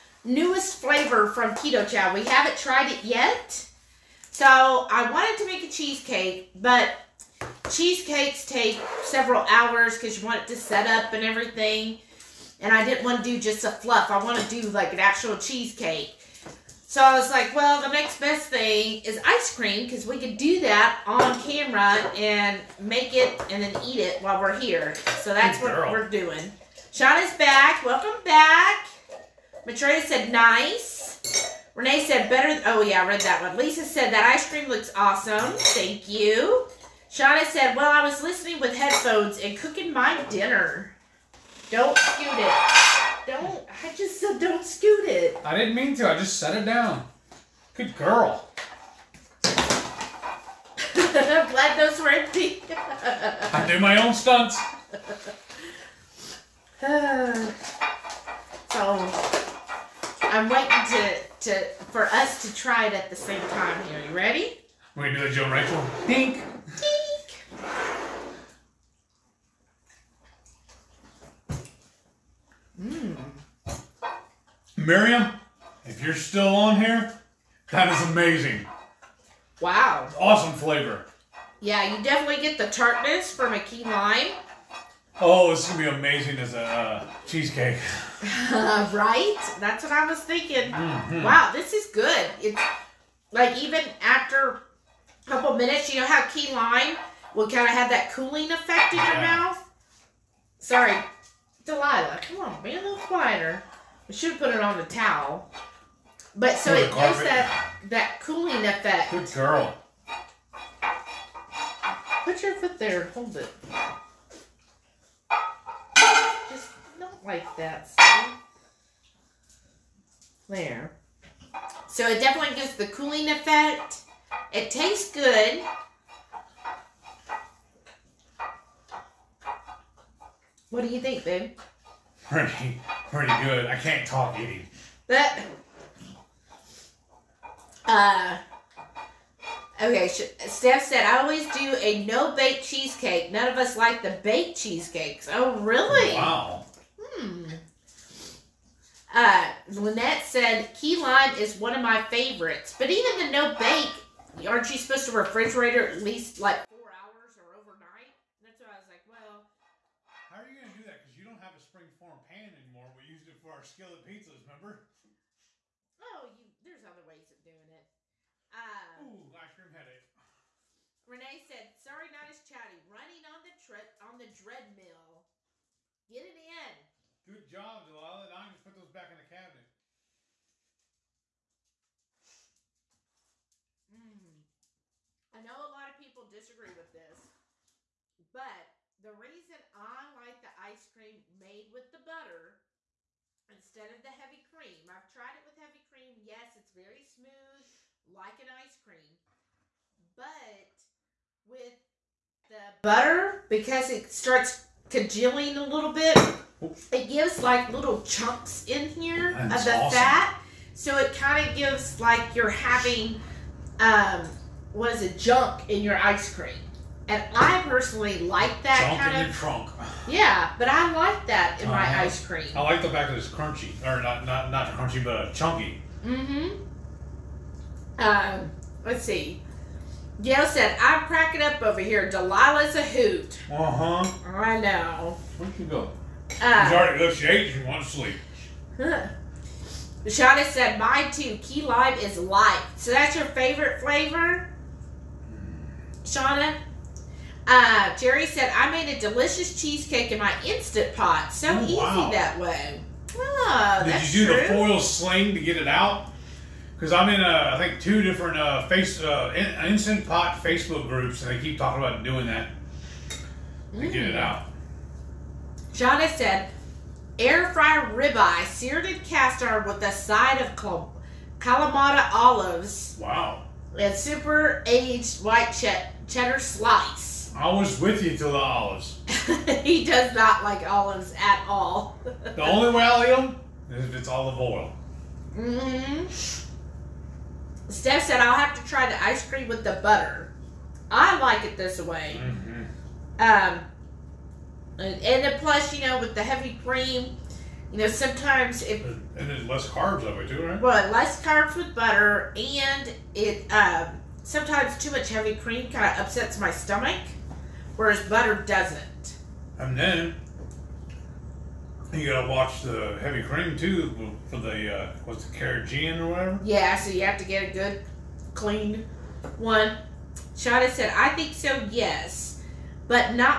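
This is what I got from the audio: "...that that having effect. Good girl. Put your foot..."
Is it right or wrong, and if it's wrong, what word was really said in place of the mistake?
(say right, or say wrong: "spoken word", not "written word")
wrong: "cooling", not "having".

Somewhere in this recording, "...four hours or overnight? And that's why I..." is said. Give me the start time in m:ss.
2:36.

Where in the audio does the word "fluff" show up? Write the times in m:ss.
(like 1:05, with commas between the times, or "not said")
0:13.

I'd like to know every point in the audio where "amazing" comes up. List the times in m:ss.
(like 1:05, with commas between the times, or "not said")
1:18, 1:25.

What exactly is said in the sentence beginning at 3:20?
But with the butter, because it starts congealing a little bit, it gives like little chunks in here That's of the awesome.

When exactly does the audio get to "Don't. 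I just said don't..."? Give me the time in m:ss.
0:43.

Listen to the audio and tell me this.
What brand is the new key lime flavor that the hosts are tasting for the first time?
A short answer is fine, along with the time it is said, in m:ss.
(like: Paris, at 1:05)
Keto Chow, at 0:01.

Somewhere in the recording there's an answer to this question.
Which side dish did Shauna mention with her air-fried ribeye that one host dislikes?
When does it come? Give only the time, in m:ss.
4:31.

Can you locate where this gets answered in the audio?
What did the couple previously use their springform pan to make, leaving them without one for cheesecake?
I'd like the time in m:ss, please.
2:43.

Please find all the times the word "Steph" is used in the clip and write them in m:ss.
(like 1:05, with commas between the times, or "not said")
2:20, 4:47.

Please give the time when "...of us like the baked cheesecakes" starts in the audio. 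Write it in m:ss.
2:23.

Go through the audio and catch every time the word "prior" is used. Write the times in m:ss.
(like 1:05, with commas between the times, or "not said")
not said.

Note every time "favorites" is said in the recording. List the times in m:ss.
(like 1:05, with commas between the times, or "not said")
2:32, 4:03.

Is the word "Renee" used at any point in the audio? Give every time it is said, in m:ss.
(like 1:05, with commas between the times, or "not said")
0:31, 2:51.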